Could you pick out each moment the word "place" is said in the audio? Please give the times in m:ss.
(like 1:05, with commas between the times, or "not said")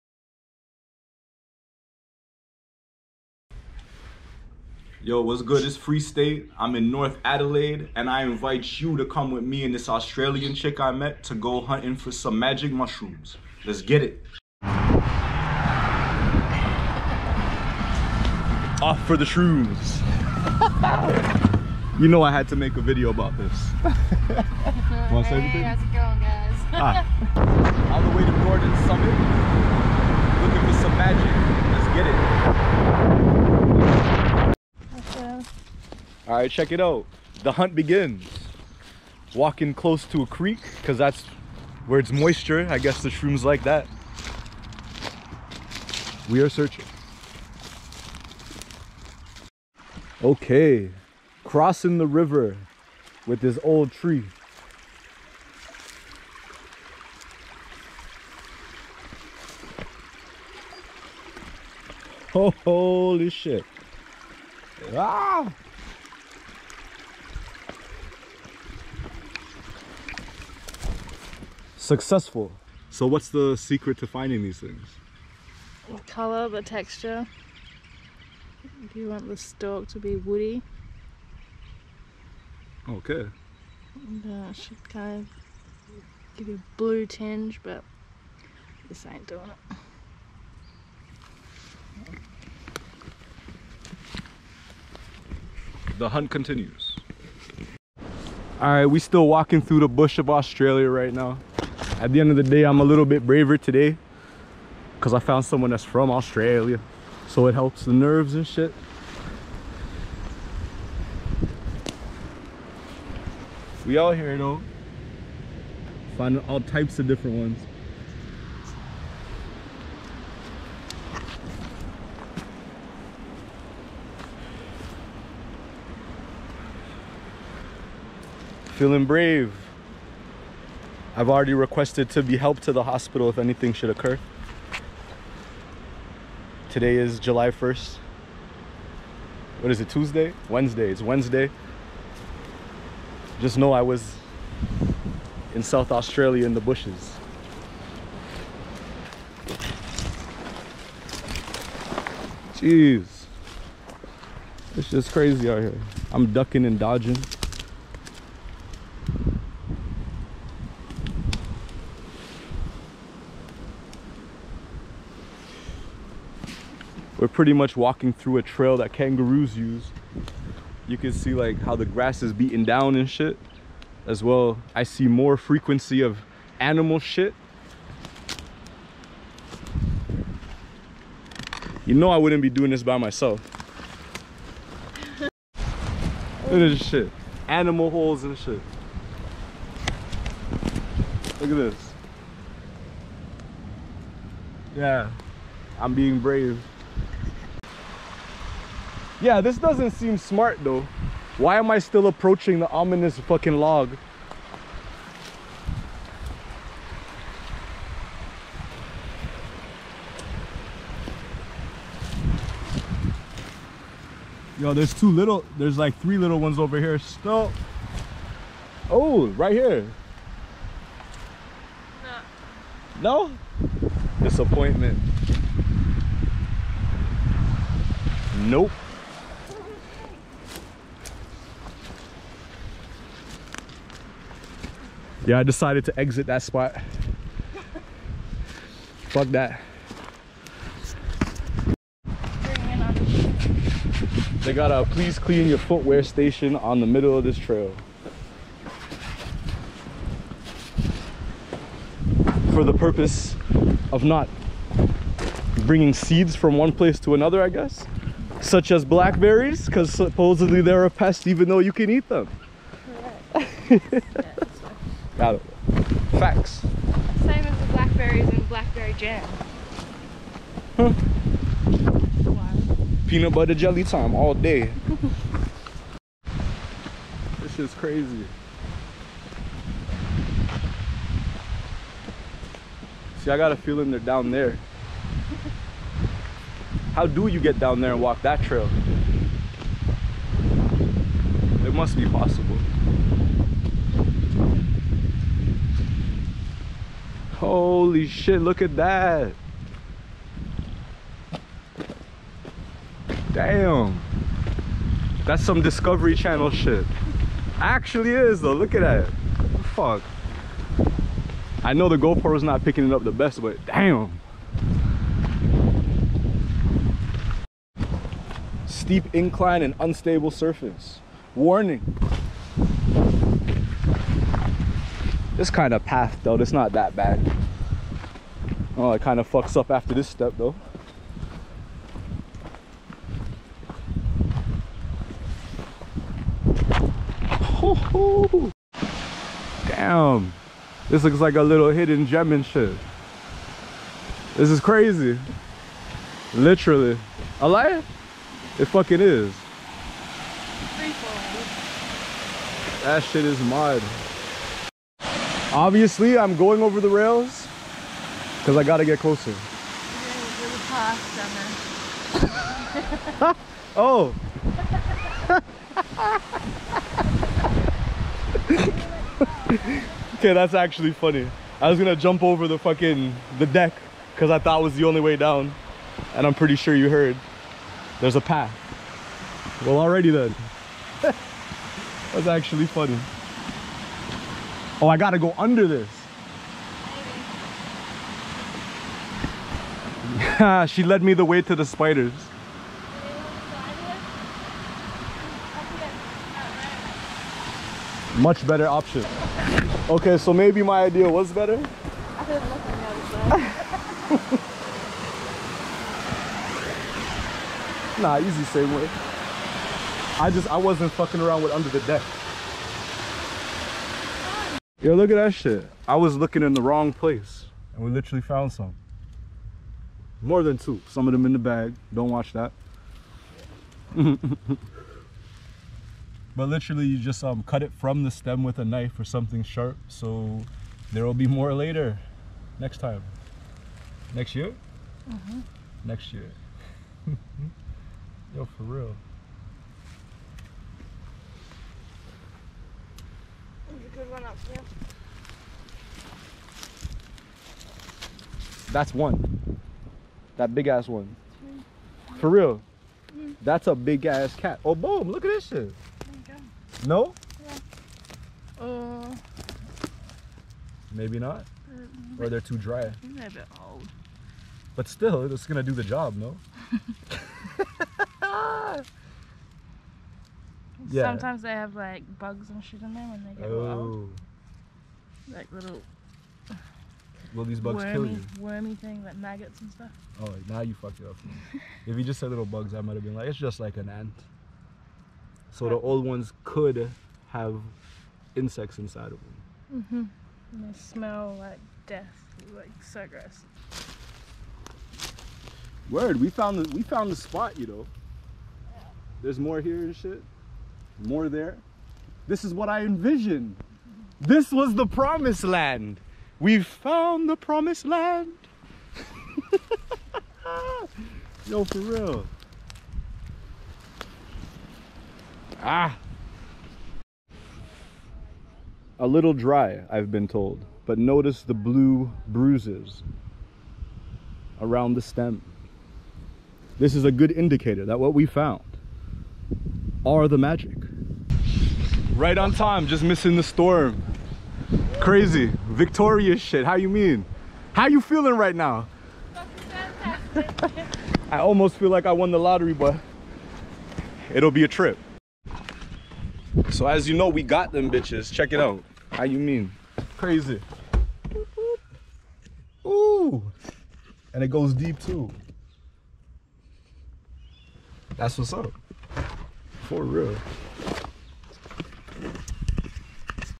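4:16, 6:56.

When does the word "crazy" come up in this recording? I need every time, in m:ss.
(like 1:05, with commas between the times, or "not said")
2:35, 4:37, 5:44, 8:54, 9:10.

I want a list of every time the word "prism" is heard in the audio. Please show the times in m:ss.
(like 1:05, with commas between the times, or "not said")
not said.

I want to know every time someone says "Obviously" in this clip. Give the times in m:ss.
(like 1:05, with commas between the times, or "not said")
5:55.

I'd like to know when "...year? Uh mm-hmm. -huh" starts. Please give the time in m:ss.
7:14.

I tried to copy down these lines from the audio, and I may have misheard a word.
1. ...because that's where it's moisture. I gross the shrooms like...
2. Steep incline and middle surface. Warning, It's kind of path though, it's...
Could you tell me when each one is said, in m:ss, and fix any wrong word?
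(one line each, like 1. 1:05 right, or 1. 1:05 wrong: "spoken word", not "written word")
1. 0:40 wrong: "guess", not "gross"
2. 5:18 wrong: "unstable", not "middle".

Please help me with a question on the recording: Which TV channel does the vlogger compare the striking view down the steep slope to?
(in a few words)
Discovery Channel.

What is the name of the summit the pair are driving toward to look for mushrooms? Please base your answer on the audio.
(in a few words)
Gordon Summit.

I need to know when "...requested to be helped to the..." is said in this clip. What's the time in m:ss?
2:11.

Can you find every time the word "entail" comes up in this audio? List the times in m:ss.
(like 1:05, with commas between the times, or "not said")
not said.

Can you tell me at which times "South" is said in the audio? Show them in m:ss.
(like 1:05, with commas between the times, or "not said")
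2:25.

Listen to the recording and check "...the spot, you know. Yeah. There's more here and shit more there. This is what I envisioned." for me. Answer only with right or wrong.
right.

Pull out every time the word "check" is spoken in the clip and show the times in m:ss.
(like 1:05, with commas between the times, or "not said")
0:36, 9:08.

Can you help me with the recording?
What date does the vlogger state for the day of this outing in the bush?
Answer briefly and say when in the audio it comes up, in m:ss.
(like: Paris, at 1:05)
July 1st, at 2:17.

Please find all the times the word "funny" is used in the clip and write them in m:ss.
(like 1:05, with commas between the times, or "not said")
6:10, 6:22.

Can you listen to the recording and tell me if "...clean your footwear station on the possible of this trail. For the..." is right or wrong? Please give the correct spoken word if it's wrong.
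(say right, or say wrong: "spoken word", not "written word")
wrong: "middle", not "possible".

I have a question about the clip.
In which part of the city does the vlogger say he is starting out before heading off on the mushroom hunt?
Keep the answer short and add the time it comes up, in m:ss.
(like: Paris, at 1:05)
North Adelaide, at 0:06.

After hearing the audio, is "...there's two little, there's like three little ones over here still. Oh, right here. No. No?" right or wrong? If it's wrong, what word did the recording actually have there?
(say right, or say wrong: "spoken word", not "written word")
right.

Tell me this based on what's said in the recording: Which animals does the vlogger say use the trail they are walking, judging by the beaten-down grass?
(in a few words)
Kangaroos.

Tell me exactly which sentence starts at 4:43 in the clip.
See, I got a feeling they're down there.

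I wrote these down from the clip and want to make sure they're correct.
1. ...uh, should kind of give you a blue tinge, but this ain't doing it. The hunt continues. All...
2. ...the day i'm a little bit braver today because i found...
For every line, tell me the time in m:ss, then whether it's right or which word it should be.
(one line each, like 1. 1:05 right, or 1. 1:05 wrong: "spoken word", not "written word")
1. 1:24 right
2. 1:42 right.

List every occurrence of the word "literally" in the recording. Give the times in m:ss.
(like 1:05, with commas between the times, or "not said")
5:46, 6:57, 7:06.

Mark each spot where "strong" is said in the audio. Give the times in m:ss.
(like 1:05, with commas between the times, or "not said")
not said.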